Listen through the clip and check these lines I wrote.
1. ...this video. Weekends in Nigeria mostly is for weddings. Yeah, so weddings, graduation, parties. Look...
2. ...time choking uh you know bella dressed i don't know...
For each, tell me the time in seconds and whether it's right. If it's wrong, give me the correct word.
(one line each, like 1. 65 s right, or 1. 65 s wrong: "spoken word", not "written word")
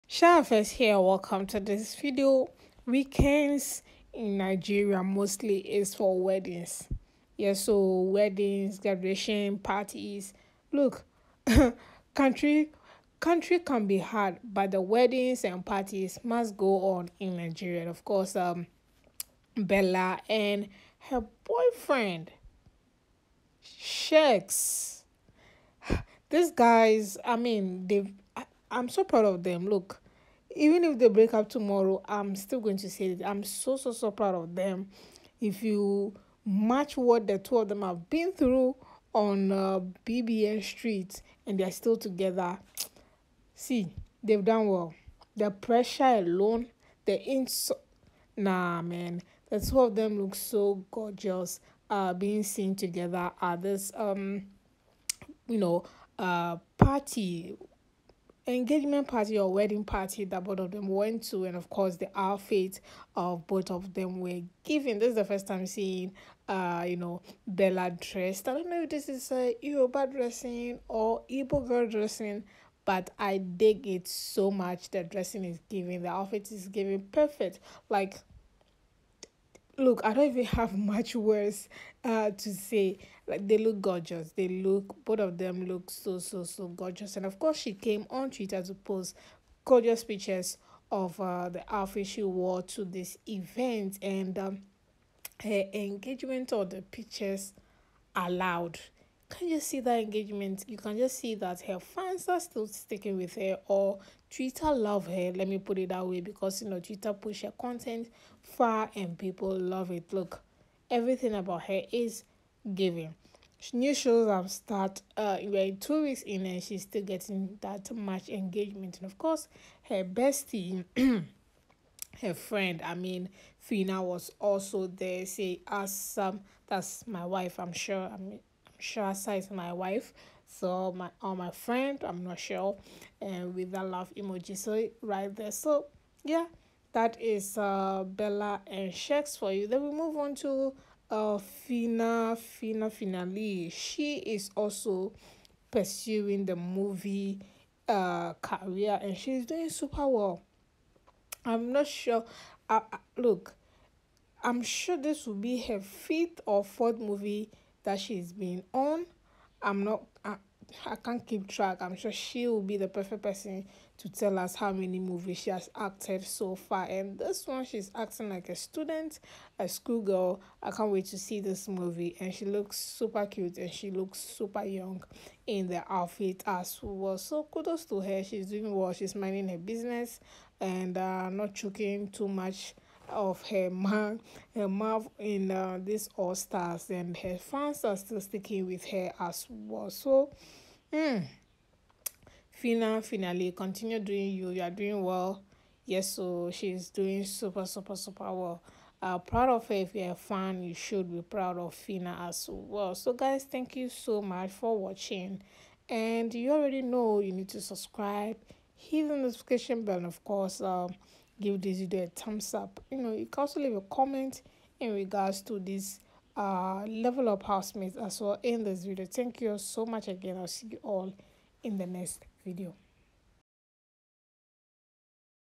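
1. 1 s right
2. 65 s wrong: "seeing", not "choking".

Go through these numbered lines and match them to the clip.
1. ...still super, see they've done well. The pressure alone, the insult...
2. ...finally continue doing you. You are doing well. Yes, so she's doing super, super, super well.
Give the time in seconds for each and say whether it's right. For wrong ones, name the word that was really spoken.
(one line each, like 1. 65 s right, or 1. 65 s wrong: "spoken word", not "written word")
1. 41 s wrong: "together", not "super"
2. 193 s right.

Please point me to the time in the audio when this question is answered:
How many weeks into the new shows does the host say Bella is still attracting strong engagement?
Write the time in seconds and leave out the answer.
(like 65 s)
115 s.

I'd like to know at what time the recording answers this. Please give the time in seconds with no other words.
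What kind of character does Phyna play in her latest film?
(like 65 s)
169 s.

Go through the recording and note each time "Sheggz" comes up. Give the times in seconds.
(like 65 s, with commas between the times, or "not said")
23 s, 138 s.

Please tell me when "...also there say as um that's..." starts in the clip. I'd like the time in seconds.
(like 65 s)
124 s.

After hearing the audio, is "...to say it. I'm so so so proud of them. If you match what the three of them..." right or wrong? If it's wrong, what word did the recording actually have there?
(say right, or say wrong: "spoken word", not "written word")
wrong: "two", not "three".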